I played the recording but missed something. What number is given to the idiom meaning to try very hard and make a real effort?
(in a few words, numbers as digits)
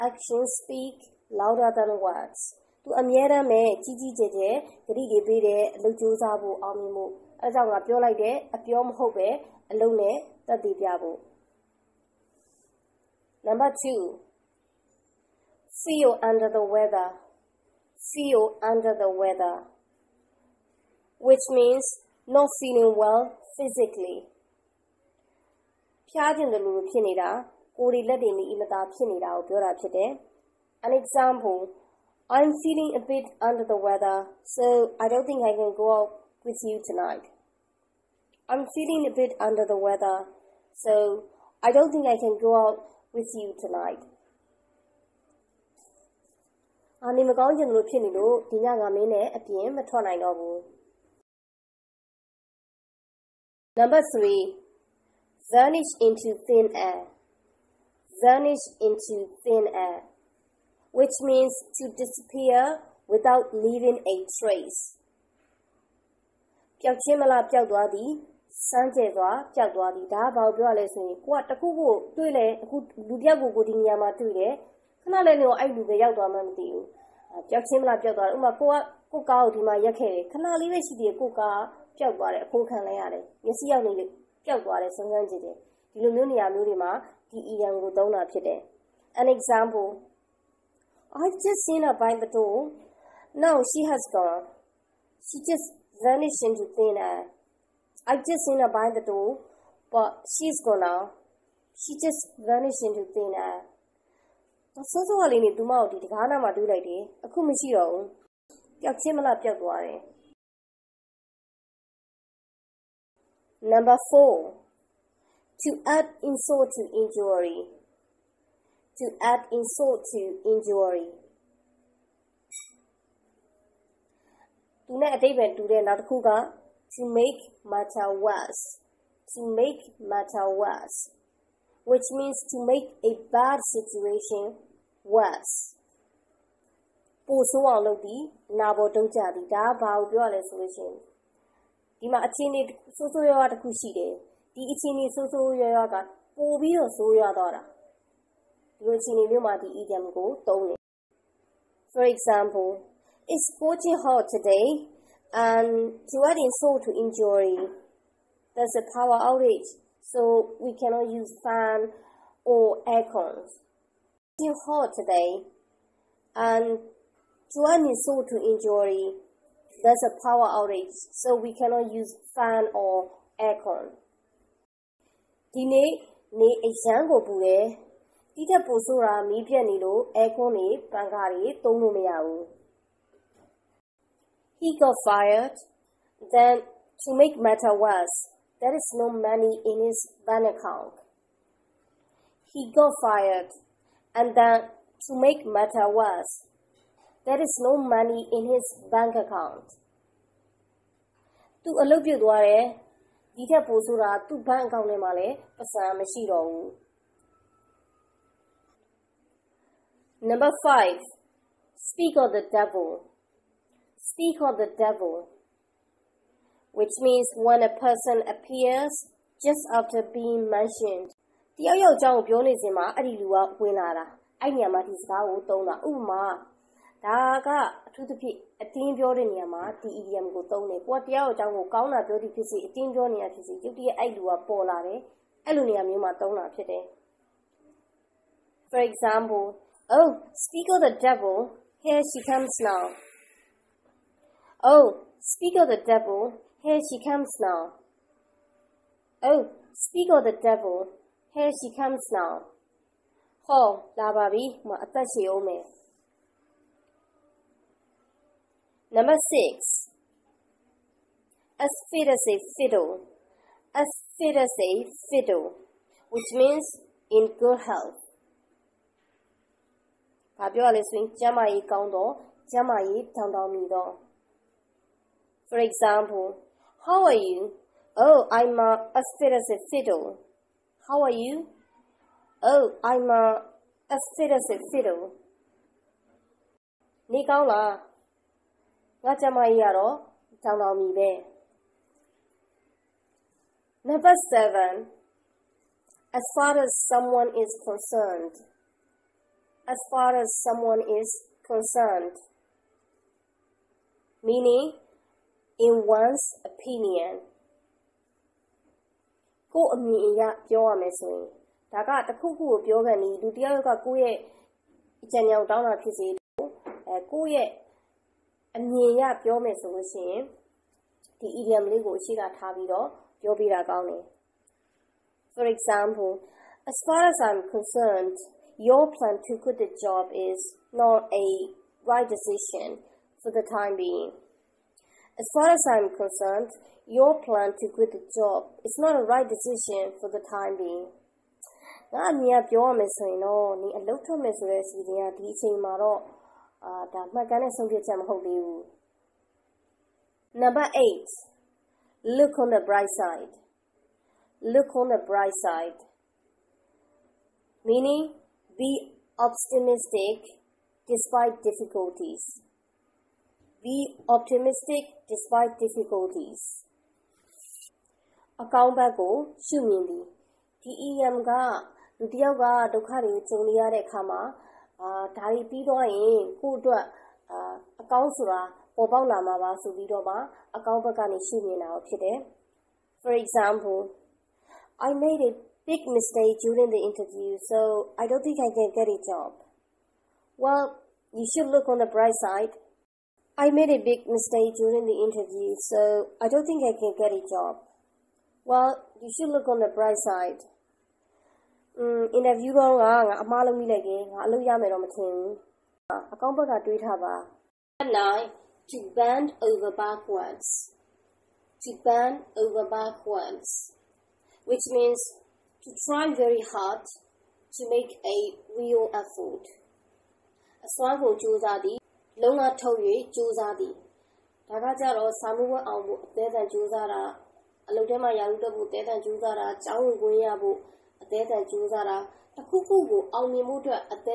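9.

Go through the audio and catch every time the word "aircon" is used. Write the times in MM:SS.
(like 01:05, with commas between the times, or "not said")
02:42, 02:53, 03:00.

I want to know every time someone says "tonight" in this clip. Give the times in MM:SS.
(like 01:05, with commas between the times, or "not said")
00:36, 00:43.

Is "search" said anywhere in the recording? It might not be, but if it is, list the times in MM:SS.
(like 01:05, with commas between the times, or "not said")
not said.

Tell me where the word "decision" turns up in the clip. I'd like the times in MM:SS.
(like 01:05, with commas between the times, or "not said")
05:32, 05:39.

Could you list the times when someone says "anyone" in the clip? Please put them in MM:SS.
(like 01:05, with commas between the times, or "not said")
not said.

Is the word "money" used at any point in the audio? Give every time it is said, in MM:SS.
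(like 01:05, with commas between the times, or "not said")
03:09, 03:17.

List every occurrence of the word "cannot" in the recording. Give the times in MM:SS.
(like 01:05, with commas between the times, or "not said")
02:40, 02:51.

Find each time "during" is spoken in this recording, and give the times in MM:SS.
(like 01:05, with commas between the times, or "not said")
06:26, 06:34.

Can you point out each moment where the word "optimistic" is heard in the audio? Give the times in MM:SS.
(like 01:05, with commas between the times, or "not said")
05:59, 06:04.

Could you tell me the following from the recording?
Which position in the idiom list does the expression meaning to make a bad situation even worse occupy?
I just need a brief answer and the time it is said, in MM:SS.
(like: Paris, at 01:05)
4, at 01:54.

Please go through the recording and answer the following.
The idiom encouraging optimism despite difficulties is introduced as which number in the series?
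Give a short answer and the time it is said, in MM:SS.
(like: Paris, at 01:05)
8, at 05:51.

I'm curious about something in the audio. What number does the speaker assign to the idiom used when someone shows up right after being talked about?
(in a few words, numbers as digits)
5.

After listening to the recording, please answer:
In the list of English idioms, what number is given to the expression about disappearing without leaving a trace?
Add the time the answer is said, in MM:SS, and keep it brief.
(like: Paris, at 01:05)
3, at 00:54.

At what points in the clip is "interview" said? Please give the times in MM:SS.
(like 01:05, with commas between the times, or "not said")
06:26, 06:35.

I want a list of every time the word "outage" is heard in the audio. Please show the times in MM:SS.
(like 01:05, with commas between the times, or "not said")
02:39, 02:50.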